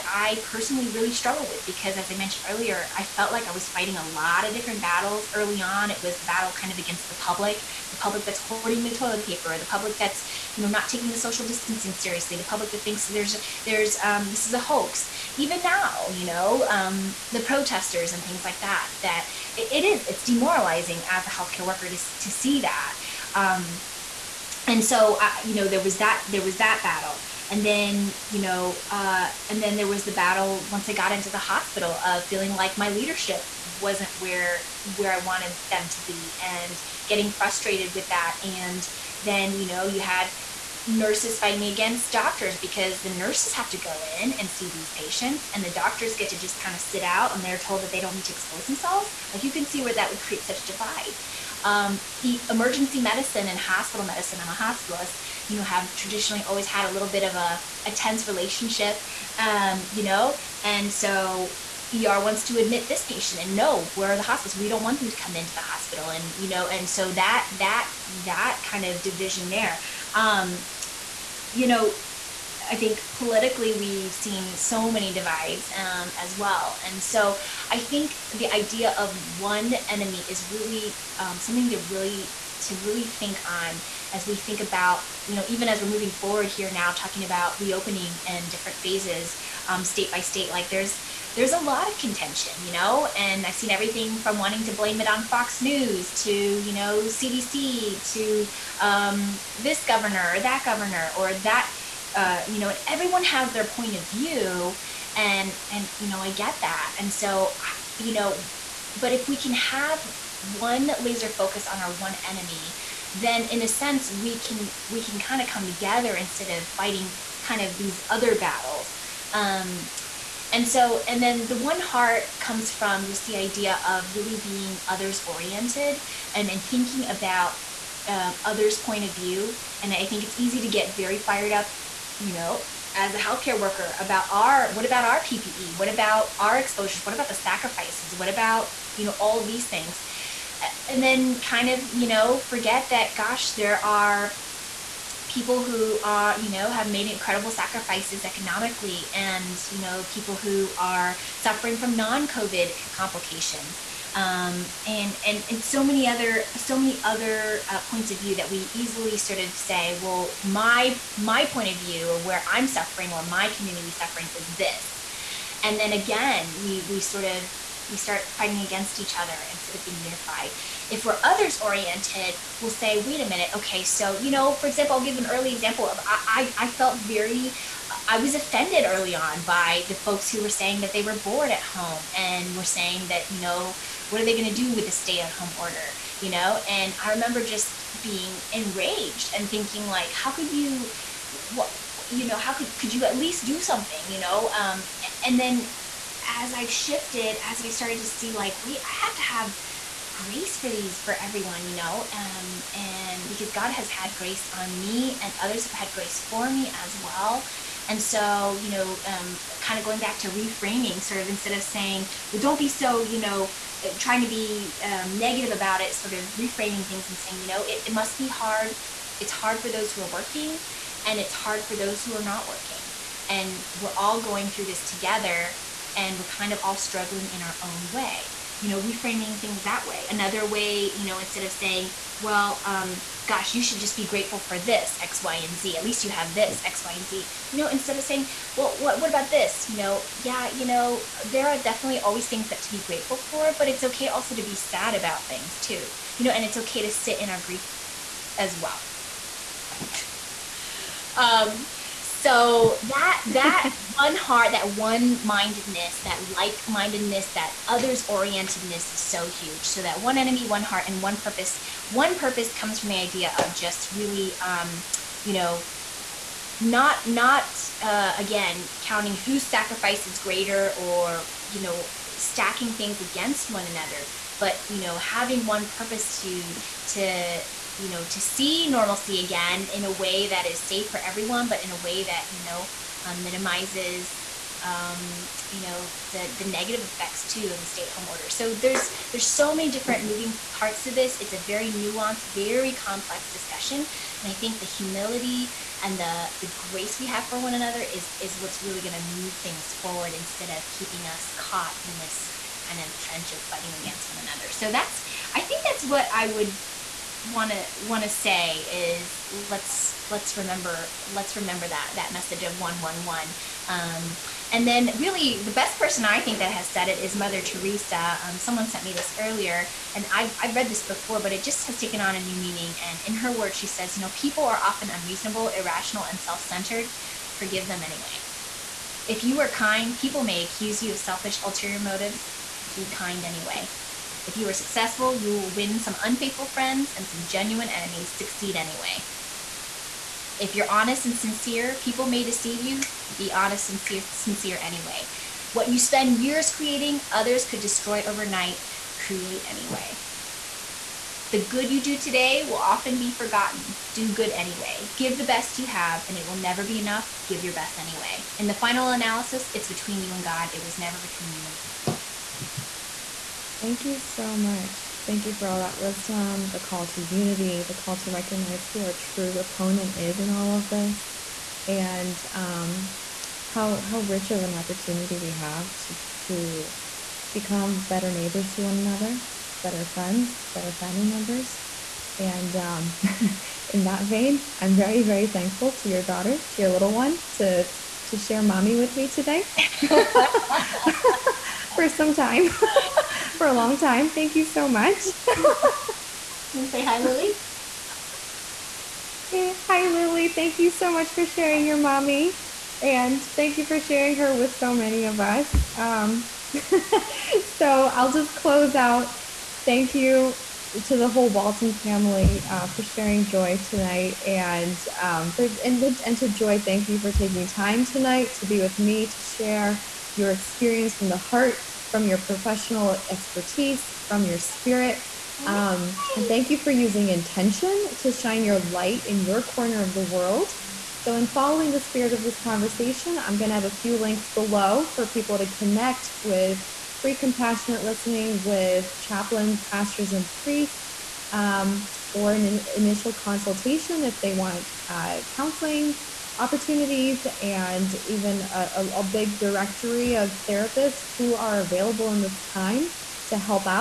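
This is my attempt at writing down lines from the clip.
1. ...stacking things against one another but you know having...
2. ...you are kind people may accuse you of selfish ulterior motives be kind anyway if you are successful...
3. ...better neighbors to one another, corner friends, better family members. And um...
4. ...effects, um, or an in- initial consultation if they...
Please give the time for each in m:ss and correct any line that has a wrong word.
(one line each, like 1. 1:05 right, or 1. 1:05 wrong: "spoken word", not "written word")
1. 4:32 right
2. 5:29 right
3. 6:17 wrong: "better", not "corner"
4. 7:20 wrong: "priests", not "effects".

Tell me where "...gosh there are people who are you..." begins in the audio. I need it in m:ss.
2:23.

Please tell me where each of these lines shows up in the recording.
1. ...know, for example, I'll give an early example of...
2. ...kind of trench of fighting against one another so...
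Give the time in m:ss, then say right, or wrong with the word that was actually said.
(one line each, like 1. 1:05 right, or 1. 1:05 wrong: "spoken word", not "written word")
1. 2:54 right
2. 5:02 right.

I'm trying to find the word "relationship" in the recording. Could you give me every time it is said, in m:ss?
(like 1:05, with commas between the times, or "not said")
0:58.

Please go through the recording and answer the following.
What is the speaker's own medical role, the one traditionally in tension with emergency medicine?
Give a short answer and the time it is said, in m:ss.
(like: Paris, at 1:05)
hospitalist, at 0:54.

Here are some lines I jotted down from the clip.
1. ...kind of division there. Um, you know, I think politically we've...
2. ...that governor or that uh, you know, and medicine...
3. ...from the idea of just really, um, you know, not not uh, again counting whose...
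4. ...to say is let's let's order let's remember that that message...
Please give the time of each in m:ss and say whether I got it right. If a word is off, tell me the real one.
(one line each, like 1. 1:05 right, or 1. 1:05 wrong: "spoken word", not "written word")
1. 1:08 right
2. 1:40 wrong: "everyone", not "medicine"
3. 4:22 right
4. 5:08 wrong: "remember", not "order".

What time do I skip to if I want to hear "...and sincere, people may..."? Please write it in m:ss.
5:41.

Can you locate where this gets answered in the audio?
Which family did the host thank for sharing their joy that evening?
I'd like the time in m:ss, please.
6:51.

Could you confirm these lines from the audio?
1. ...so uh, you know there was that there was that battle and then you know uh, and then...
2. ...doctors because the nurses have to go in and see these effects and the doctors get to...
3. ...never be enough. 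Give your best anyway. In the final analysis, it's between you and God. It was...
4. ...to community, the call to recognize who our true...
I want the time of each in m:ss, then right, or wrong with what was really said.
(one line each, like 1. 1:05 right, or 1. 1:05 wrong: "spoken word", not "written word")
1. 0:24 right
2. 0:42 wrong: "patients", not "effects"
3. 5:56 right
4. 6:06 wrong: "unity", not "community".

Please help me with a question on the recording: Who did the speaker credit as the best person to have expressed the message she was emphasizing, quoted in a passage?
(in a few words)
Mother Teresa.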